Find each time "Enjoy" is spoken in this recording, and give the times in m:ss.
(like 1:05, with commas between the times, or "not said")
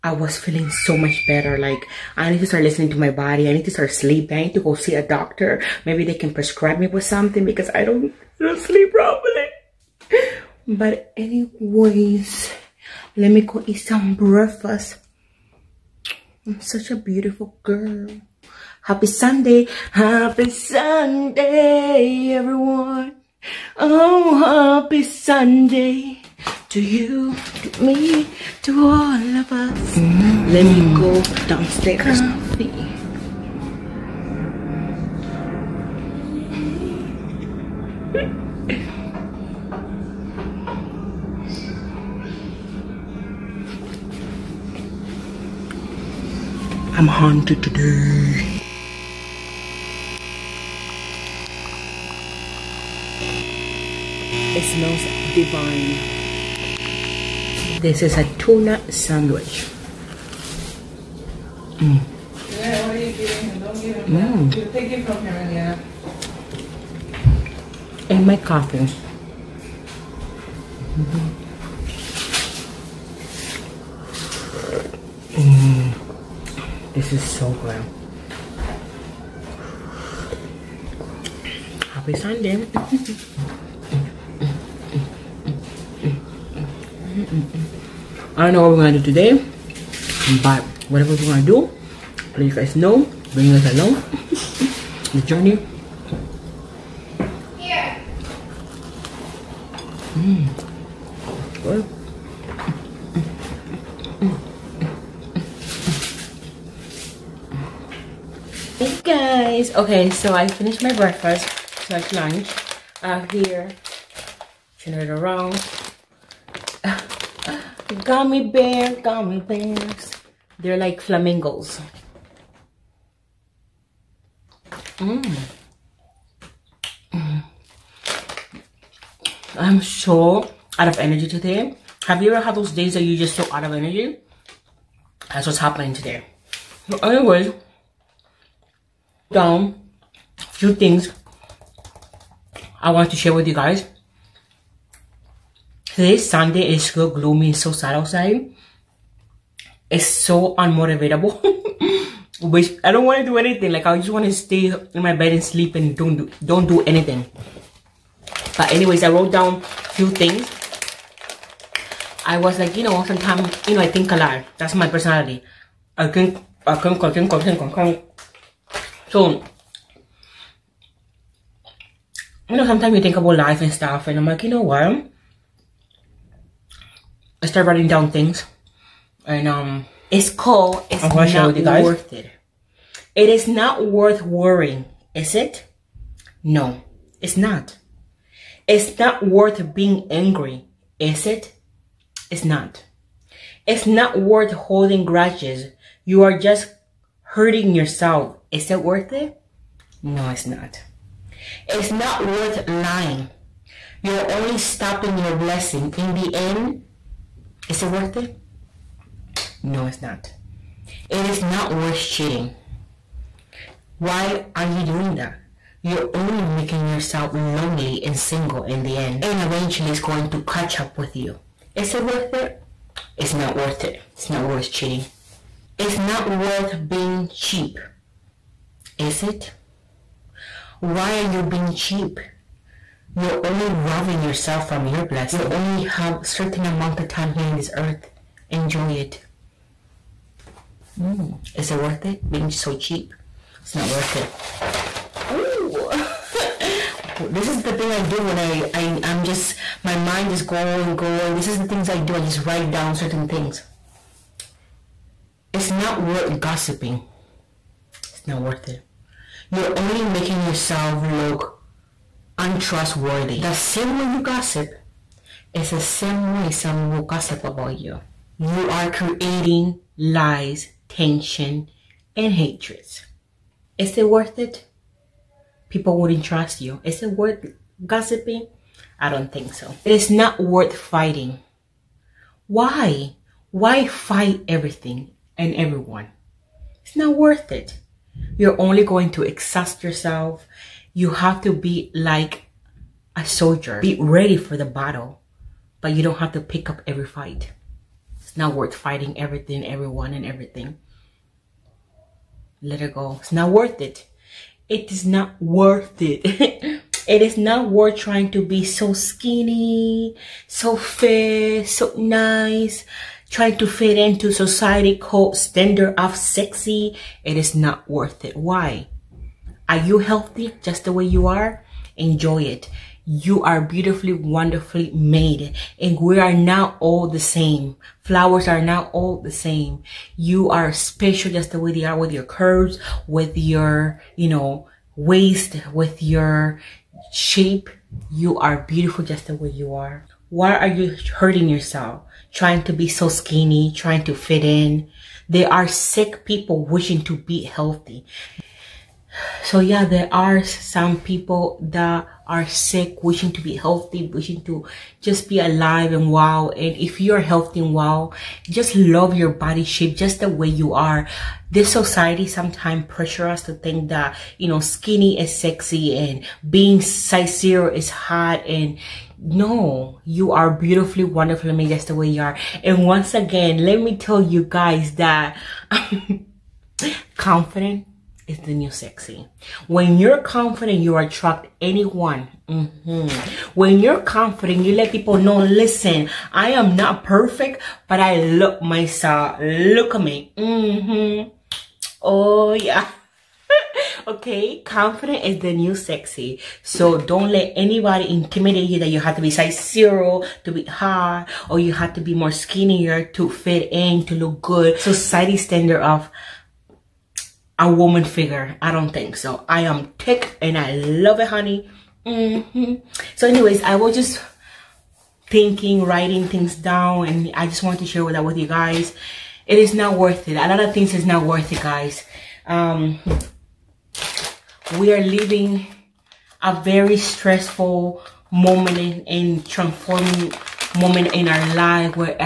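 3:58, 5:21.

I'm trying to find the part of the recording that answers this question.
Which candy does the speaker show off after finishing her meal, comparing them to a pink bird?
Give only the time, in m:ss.
1:57.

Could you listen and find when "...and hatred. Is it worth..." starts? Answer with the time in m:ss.
4:32.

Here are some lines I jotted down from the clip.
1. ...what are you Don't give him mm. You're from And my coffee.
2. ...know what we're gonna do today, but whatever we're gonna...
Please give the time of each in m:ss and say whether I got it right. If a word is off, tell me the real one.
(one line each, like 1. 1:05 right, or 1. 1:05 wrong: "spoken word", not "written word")
1. 1:02 right
2. 1:28 right.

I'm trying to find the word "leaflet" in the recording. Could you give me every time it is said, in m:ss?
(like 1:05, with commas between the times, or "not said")
not said.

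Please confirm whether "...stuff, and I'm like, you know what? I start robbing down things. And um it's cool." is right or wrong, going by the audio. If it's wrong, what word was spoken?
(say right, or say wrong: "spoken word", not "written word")
wrong: "writing", not "robbing".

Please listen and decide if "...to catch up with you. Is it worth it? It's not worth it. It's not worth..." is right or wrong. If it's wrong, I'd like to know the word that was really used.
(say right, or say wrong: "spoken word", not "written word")
right.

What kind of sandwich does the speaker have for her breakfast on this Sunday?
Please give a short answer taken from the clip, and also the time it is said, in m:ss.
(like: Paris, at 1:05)
Tuna, at 0:58.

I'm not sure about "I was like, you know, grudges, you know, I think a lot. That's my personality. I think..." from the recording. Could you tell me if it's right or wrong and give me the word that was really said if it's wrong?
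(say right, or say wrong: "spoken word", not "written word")
wrong: "sometimes", not "grudges".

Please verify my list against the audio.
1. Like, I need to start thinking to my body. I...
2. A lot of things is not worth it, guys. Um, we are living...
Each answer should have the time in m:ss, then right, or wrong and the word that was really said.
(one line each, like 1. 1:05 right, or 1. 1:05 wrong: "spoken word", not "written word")
1. 0:01 wrong: "listening", not "thinking"
2. 7:00 right.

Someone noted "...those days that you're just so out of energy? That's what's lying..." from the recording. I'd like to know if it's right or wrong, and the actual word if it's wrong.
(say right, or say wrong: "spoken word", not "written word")
wrong: "happening", not "lying".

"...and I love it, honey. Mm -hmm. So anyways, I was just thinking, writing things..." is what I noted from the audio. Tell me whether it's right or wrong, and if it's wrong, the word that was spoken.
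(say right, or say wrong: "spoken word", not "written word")
right.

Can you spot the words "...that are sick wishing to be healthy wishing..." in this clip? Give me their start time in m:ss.
5:51.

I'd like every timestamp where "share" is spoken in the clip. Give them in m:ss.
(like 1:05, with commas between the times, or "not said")
2:23, 6:57.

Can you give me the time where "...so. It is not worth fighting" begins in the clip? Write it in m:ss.
4:39.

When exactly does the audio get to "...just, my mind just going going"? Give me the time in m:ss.
4:09.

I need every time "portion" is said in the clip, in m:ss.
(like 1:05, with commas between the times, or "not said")
not said.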